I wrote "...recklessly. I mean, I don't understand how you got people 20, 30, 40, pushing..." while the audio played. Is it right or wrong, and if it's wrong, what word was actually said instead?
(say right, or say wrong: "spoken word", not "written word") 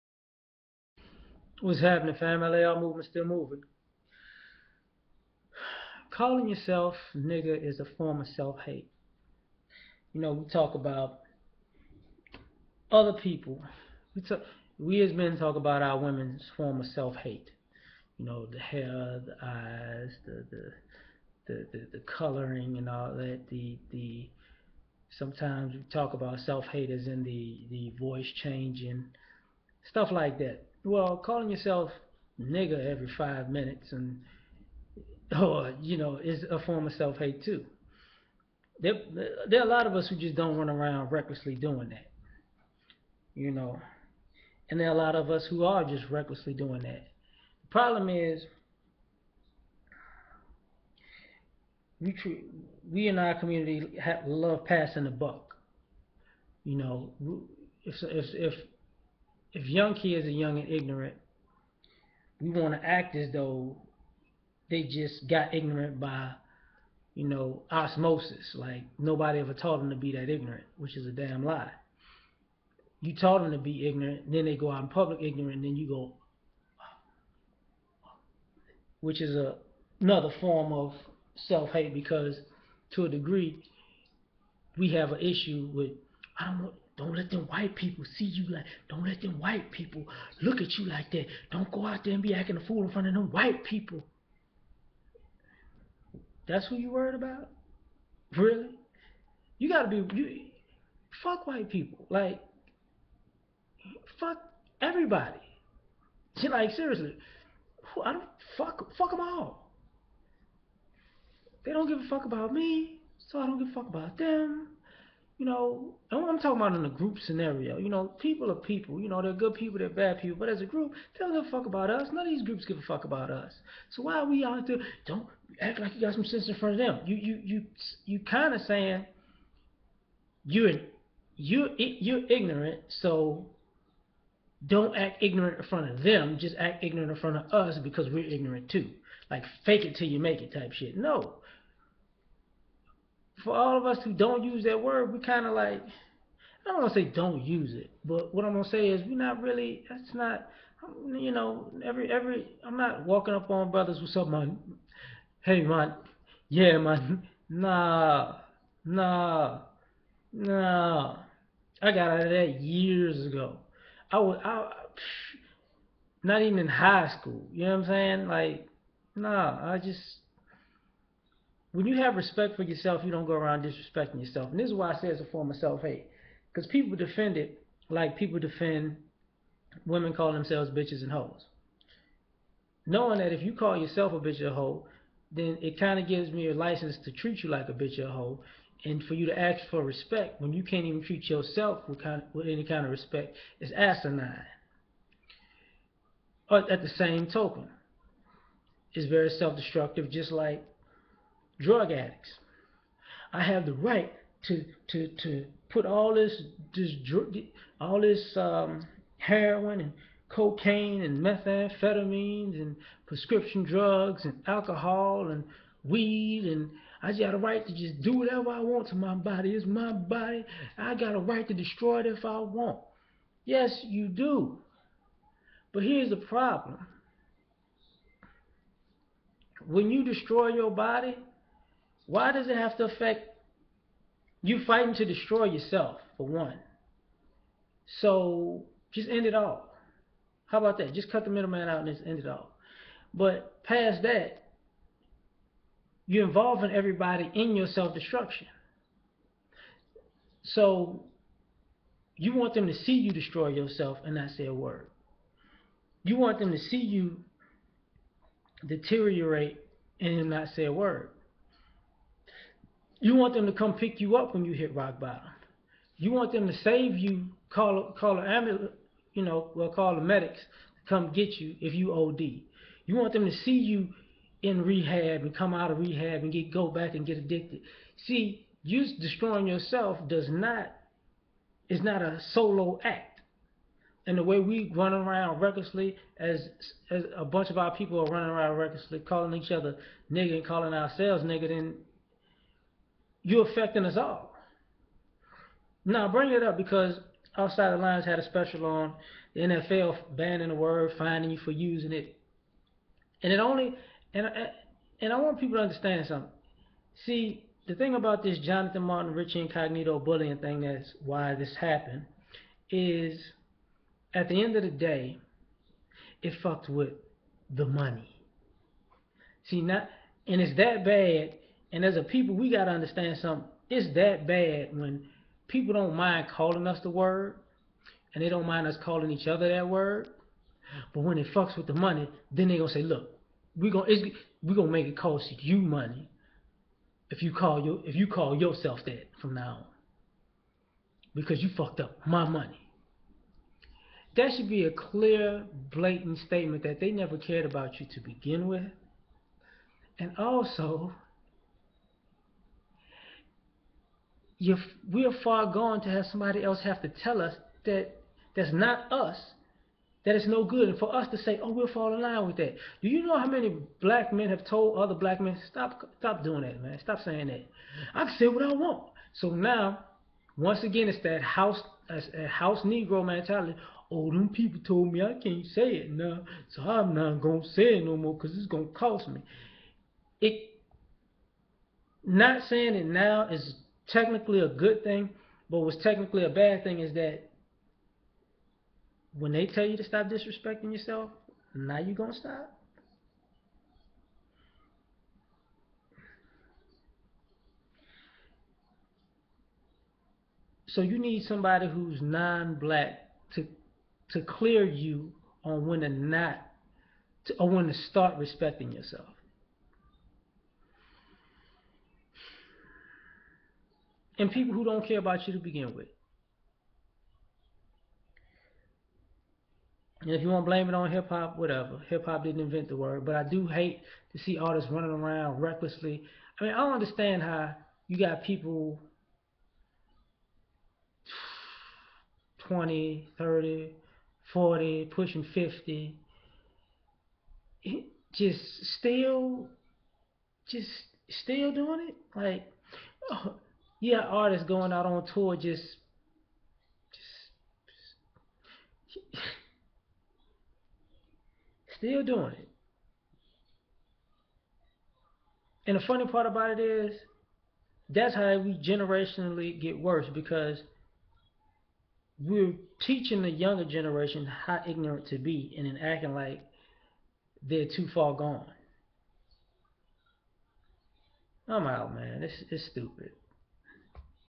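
right.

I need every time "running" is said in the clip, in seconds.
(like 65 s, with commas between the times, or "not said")
288 s, 424 s.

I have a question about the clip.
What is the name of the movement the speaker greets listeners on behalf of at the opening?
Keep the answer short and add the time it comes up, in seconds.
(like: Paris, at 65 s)
LAR movement, at 2 s.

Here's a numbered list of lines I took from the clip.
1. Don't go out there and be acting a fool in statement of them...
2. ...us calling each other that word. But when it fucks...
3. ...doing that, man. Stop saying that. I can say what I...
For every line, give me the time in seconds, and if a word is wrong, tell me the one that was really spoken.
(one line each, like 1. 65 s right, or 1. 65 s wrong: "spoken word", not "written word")
1. 91 s wrong: "front", not "statement"
2. 328 s right
3. 366 s right.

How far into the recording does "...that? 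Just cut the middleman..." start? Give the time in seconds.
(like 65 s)
240 s.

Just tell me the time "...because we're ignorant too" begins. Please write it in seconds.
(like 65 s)
137 s.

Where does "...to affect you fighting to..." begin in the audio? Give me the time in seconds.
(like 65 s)
232 s.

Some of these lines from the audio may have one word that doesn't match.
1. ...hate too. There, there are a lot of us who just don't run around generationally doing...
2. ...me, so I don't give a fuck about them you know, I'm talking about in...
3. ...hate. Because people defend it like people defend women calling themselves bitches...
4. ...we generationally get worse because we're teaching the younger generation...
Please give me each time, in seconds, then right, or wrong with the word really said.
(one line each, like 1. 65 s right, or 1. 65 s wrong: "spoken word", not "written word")
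1. 37 s wrong: "recklessly", not "generationally"
2. 112 s right
3. 175 s right
4. 458 s right.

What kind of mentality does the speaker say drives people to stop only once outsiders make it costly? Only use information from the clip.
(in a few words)
House Negro mentality.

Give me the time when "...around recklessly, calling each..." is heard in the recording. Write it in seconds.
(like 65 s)
288 s.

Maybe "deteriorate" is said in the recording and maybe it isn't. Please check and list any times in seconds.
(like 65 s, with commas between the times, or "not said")
258 s.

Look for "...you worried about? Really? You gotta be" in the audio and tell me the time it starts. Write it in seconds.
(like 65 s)
96 s.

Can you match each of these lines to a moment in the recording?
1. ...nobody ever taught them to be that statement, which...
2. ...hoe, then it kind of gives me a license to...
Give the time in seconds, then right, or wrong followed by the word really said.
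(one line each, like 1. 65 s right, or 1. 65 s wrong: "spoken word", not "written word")
1. 68 s wrong: "ignorant", not "statement"
2. 184 s right.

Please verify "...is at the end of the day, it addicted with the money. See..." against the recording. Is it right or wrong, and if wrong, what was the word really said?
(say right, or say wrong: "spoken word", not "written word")
wrong: "fucked", not "addicted".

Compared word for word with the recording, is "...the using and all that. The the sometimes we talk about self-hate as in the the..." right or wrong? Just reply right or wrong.
wrong.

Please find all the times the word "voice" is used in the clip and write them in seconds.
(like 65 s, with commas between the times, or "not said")
27 s.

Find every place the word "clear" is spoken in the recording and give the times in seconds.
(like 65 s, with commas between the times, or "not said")
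344 s, 404 s.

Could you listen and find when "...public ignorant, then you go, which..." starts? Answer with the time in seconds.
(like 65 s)
74 s.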